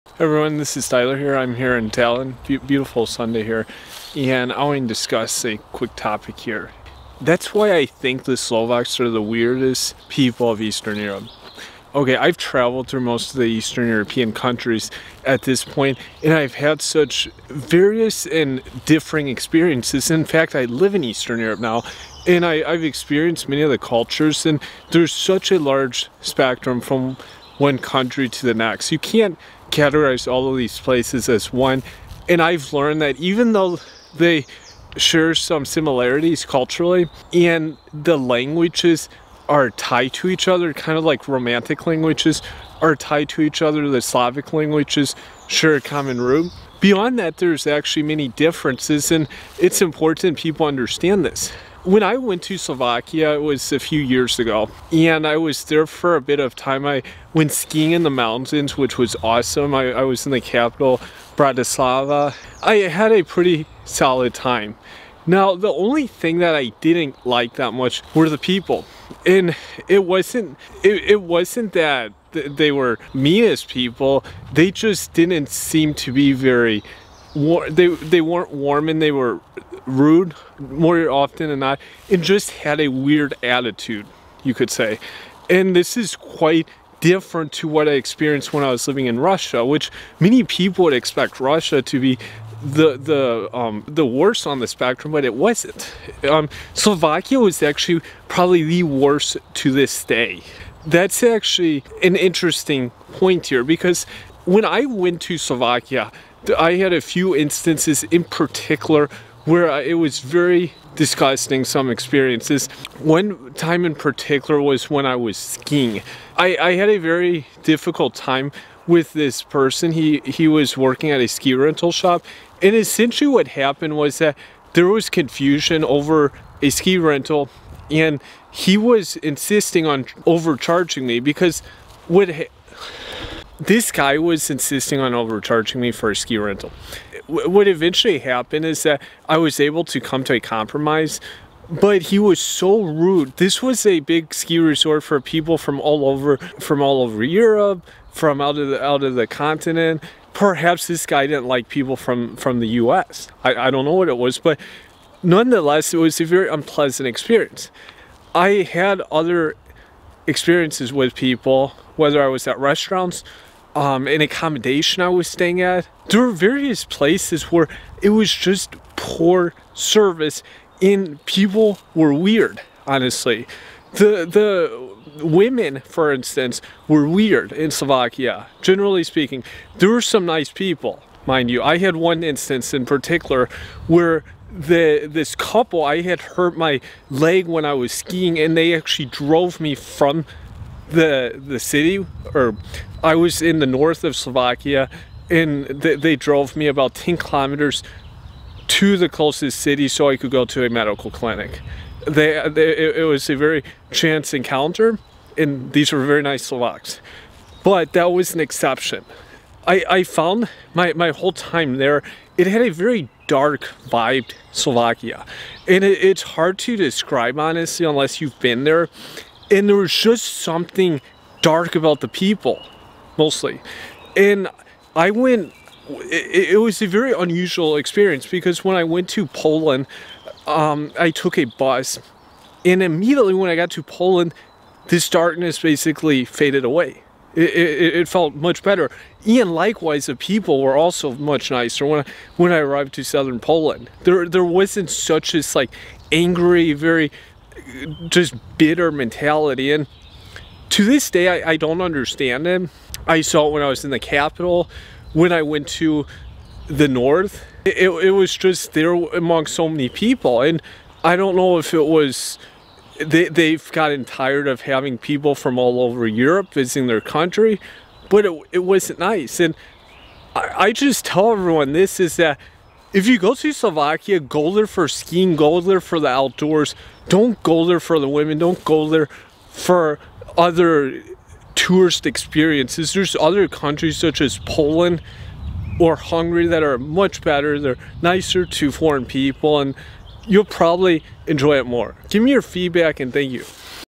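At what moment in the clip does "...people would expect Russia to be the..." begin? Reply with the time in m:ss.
1:30.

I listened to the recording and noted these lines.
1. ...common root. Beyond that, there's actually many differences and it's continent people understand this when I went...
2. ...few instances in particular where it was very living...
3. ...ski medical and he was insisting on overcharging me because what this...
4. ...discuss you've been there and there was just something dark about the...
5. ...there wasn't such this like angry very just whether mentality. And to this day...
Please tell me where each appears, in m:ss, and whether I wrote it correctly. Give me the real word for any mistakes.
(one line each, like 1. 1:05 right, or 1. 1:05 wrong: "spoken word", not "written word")
1. 0:45 wrong: "important", not "continent"
2. 1:47 wrong: "disgusting", not "living"
3. 2:06 wrong: "rental", not "medical"
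4. 3:37 wrong: "unless", not "discuss"
5. 4:04 wrong: "bitter", not "whether".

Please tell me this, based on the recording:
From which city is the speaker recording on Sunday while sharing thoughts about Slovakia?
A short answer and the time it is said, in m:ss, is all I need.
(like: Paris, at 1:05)
Tallinn, at 0:01.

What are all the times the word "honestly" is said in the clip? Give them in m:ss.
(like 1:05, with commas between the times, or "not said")
2:52, 3:37.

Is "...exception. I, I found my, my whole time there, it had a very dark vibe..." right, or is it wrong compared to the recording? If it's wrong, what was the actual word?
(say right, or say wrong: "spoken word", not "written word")
right.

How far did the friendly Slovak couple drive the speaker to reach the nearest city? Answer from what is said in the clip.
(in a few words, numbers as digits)
10 kilometers.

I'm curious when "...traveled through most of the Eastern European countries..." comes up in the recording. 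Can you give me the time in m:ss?
0:12.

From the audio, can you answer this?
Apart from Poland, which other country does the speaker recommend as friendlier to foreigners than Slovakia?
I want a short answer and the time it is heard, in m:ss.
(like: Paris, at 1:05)
Hungary, at 4:45.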